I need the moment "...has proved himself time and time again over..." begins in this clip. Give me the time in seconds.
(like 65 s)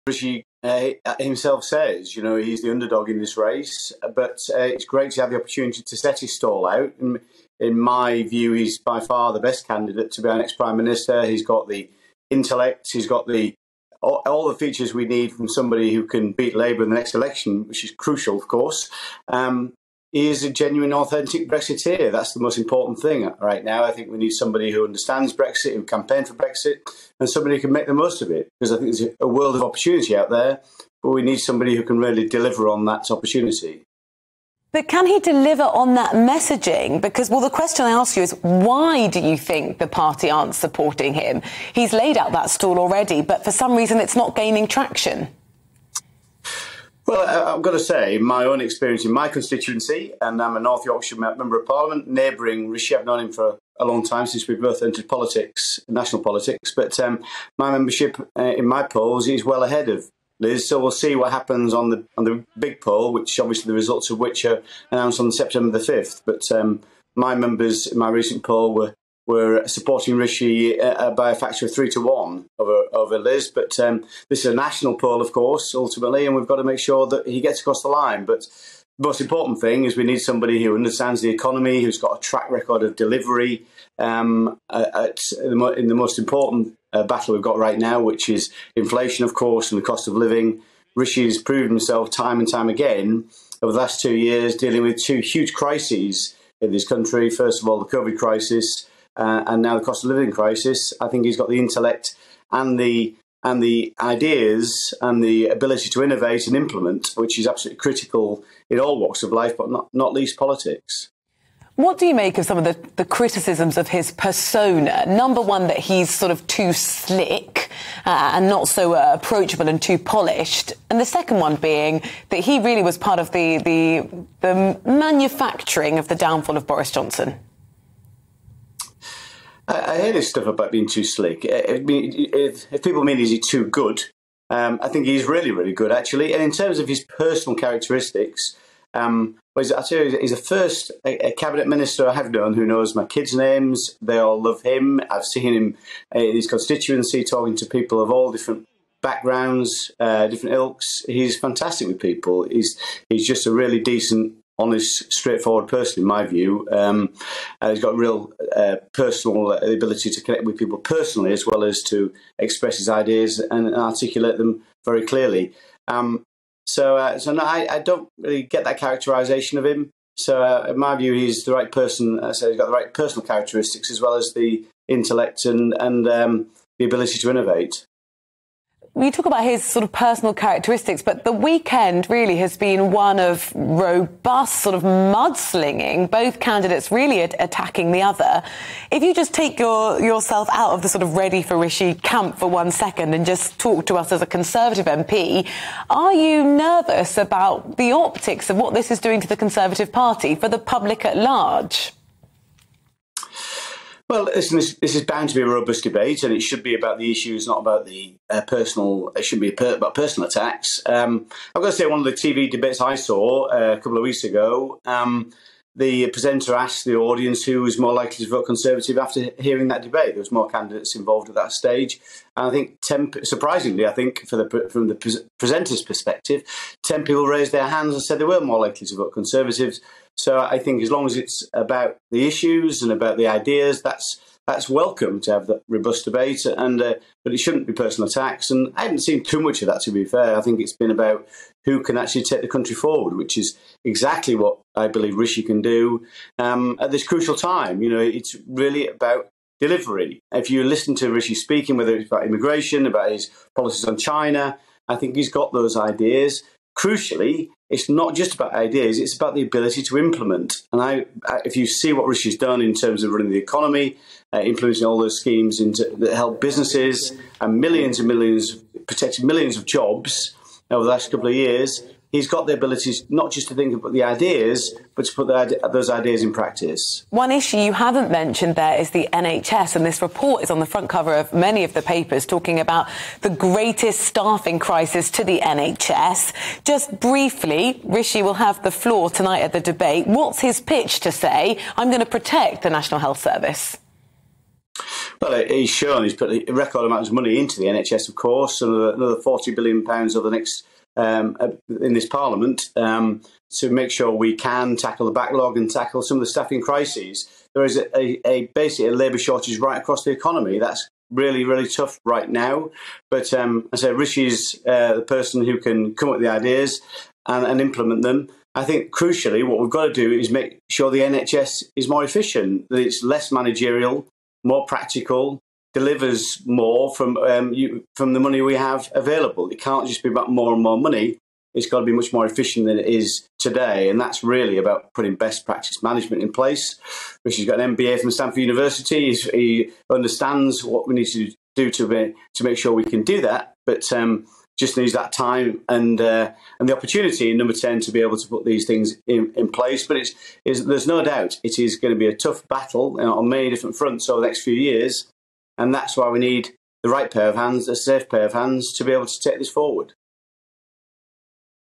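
91 s.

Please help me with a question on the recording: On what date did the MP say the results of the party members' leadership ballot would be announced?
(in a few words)
September 5.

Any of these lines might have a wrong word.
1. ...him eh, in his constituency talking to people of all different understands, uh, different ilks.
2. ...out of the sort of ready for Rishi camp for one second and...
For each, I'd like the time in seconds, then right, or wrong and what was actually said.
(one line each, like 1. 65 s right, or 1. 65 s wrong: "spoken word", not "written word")
1. 145 s wrong: "backgrounds", not "understands"
2. 190 s right.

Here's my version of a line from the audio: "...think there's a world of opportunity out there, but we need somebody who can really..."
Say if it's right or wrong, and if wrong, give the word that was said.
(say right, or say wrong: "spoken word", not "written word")
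right.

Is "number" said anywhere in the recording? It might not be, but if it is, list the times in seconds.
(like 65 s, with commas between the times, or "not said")
115 s, 347 s.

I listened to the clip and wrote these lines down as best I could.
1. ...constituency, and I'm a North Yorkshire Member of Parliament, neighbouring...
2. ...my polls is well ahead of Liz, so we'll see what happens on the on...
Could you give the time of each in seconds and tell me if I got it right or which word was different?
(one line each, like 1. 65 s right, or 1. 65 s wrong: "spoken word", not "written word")
1. 49 s right
2. 58 s right.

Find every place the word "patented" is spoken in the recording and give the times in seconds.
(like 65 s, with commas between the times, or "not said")
not said.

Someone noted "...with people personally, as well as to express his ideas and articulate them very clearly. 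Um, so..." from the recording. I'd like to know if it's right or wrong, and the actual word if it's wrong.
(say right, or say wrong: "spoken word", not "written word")
right.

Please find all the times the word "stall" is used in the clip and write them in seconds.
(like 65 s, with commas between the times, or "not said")
6 s, 42 s.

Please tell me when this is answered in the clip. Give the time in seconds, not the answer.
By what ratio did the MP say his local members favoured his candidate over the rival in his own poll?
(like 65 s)
71 s.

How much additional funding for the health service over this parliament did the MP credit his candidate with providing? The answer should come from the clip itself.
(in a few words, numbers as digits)
£40 billion.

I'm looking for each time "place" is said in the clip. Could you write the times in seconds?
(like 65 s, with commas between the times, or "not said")
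336 s, 349 s.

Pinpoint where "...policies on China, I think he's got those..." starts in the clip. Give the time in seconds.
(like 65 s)
253 s.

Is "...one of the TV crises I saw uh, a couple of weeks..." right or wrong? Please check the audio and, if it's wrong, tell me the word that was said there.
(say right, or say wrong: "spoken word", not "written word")
wrong: "debates", not "crises".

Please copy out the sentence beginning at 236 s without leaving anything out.
And uh, but it shouldn't be personal attacks.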